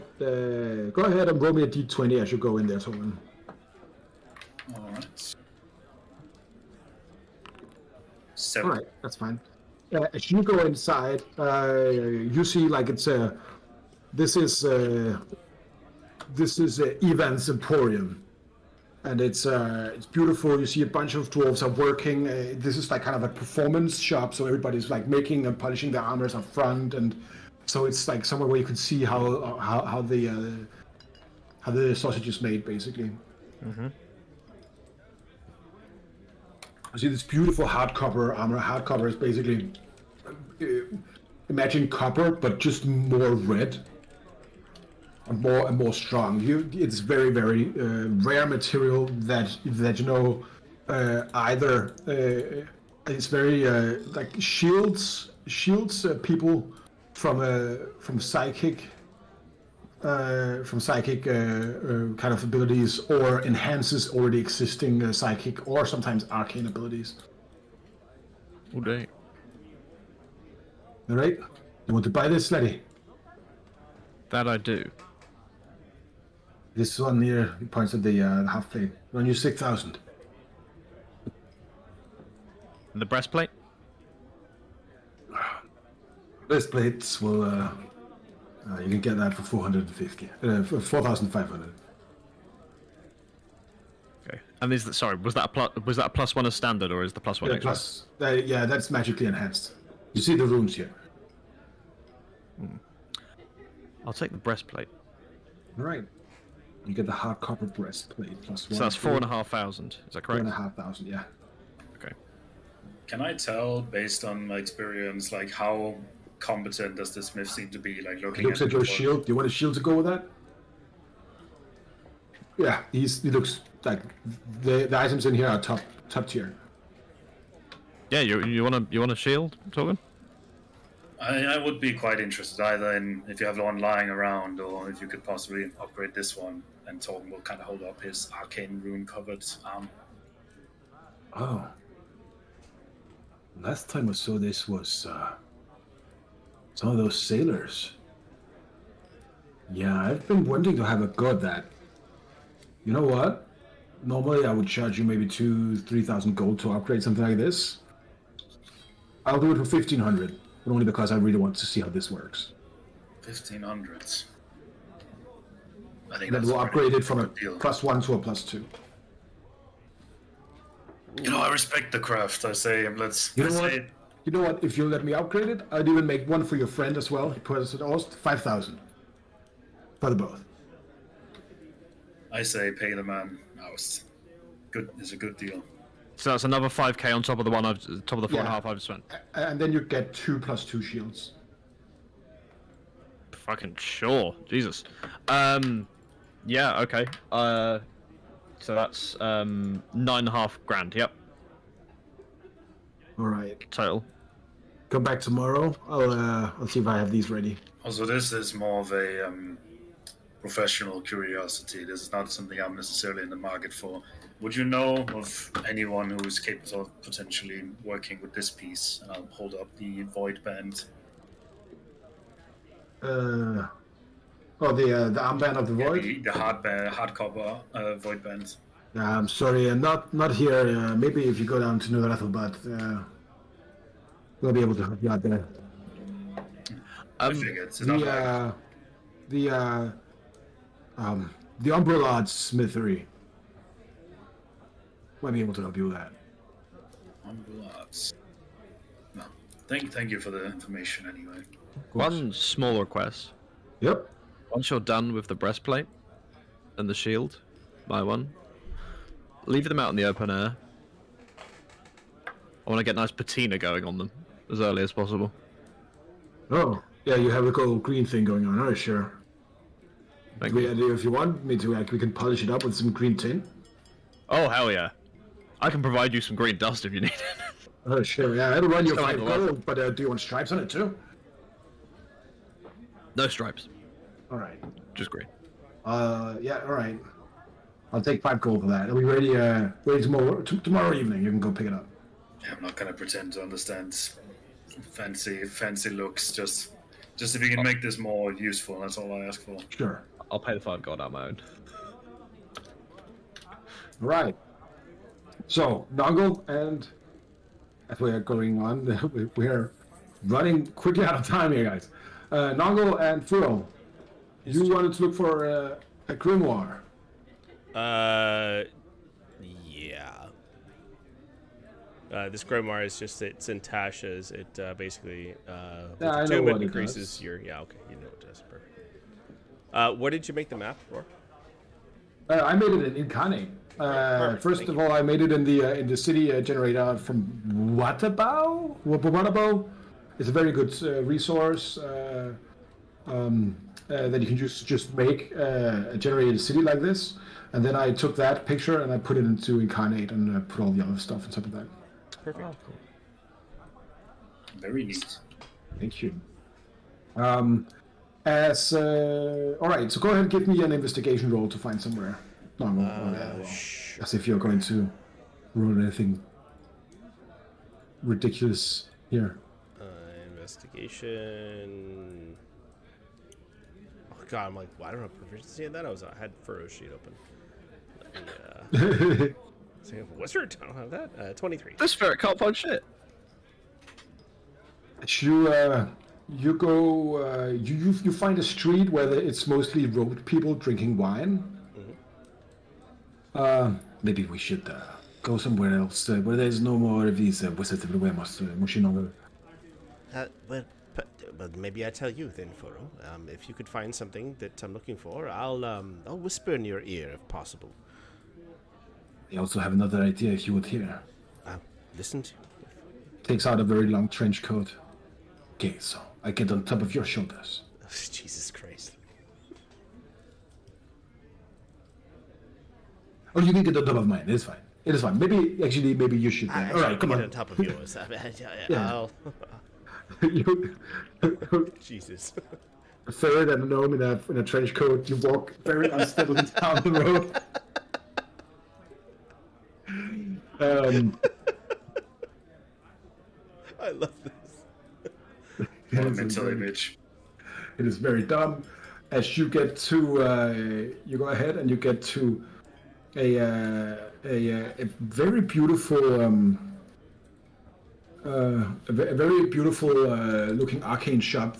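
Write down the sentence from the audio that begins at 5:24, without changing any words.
It uh, basically uh, with yeah, the it increases does.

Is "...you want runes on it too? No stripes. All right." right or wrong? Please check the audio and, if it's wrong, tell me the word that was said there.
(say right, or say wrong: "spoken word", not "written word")
wrong: "stripes", not "runes".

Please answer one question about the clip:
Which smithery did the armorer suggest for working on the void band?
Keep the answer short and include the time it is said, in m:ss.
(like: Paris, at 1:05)
Umbrelad Smithery, at 4:01.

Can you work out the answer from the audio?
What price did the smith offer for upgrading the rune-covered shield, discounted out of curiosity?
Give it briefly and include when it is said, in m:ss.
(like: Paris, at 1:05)
1,500, at 2:39.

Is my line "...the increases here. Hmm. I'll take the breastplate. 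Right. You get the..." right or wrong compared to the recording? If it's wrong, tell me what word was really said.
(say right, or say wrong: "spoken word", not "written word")
wrong: "runes", not "increases".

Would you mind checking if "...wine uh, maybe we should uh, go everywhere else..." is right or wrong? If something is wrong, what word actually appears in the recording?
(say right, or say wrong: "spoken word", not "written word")
wrong: "somewhere", not "everywhere".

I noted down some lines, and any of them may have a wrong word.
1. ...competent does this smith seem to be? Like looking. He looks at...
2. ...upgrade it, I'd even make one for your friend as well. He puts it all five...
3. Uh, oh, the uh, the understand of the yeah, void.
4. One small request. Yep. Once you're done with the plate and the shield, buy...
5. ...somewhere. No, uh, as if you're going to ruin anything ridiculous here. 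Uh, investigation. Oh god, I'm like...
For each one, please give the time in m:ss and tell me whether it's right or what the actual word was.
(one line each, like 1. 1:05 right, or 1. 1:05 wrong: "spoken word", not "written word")
1. 1:56 right
2. 2:55 right
3. 3:43 wrong: "armband", not "understand"
4. 4:11 wrong: "breastplate", not "plate"
5. 6:01 right.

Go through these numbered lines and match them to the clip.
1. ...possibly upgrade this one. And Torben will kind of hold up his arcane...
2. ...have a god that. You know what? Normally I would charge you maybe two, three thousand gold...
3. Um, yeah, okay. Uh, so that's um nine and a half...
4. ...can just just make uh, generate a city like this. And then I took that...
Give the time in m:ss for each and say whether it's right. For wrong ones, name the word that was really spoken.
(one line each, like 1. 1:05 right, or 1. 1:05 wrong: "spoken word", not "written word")
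1. 2:15 right
2. 2:30 right
3. 3:15 right
4. 5:44 right.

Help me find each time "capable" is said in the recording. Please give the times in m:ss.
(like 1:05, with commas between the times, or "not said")
3:36.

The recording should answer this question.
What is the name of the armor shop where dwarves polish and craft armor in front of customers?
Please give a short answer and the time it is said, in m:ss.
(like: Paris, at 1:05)
Ivan's Emporium, at 0:17.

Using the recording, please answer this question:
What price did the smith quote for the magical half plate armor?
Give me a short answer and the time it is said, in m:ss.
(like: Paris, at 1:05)
6,000, at 1:19.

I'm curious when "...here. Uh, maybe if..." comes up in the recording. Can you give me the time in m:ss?
3:50.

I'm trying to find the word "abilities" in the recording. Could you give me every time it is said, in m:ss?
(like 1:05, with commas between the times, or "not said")
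1:02, 1:06.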